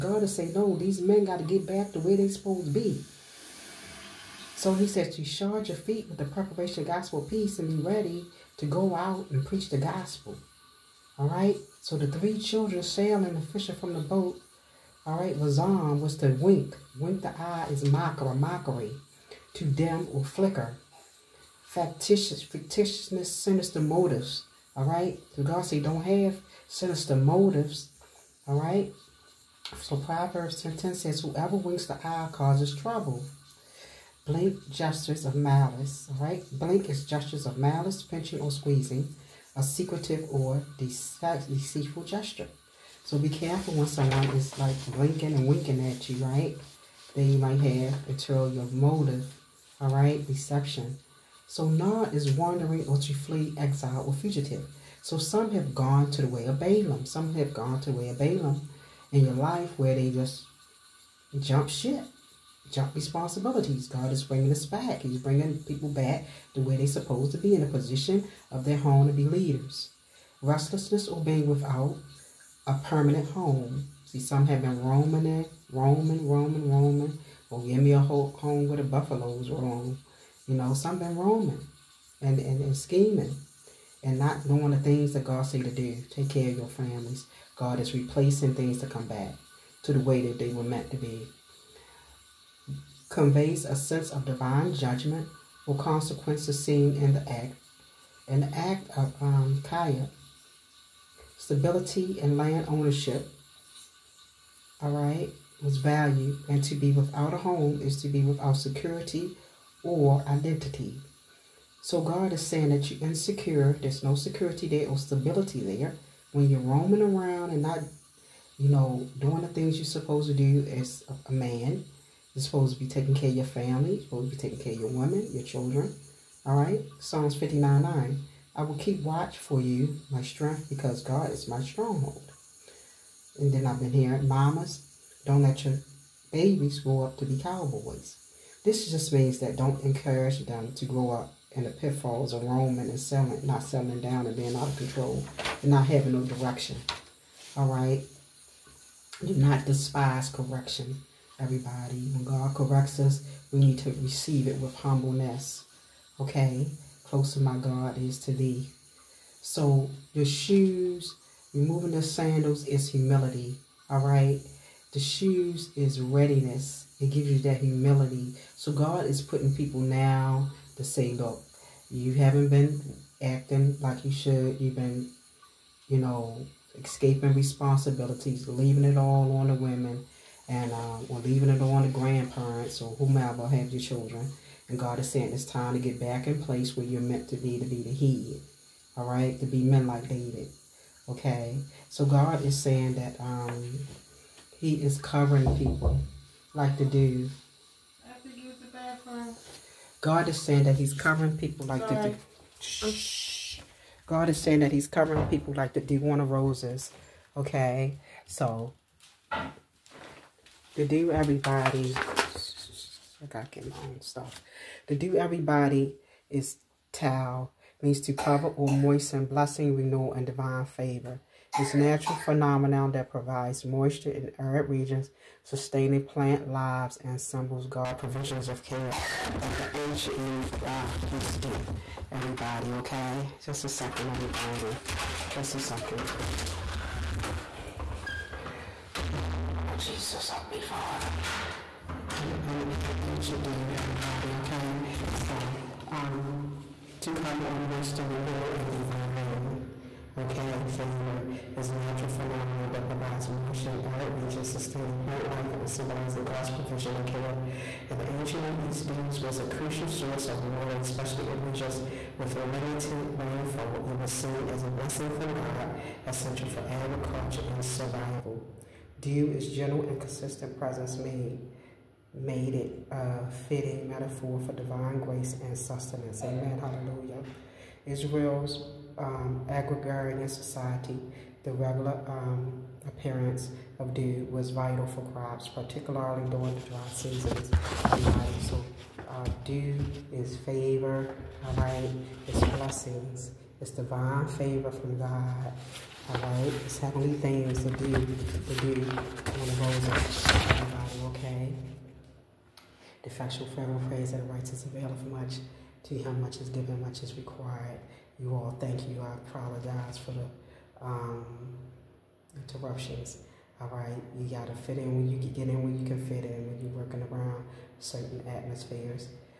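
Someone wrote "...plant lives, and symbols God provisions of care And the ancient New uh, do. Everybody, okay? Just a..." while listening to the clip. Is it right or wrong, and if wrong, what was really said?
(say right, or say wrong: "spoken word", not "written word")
right.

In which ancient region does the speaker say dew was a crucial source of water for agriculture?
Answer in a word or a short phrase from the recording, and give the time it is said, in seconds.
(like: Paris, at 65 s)
Near East, at 258 s.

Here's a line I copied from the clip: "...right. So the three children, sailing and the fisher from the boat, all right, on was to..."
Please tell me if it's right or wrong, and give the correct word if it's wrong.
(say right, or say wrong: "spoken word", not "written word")
right.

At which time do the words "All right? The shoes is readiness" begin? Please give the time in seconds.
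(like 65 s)
163 s.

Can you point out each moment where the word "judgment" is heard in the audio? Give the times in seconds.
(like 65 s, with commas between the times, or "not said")
94 s.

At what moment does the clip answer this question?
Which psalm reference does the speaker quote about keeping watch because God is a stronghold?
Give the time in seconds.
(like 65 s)
126 s.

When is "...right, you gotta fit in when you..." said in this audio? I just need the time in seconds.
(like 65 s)
313 s.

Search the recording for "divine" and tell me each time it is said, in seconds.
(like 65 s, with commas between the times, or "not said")
94 s, 220 s, 248 s, 274 s, 293 s.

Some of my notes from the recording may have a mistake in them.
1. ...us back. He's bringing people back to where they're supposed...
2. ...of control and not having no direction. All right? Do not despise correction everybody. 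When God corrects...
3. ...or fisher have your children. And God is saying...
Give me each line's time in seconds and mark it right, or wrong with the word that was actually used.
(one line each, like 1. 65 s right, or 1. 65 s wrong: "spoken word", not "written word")
1. 64 s right
2. 144 s right
3. 182 s wrong: "whomever", not "fisher".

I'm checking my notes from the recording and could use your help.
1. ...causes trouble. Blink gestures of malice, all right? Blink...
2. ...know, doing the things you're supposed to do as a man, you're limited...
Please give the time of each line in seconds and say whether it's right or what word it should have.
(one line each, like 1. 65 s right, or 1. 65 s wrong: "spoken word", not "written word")
1. 32 s right
2. 118 s wrong: "supposed", not "limited".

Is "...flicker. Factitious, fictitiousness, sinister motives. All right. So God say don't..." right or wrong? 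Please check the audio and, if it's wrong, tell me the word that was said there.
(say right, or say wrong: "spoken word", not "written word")
right.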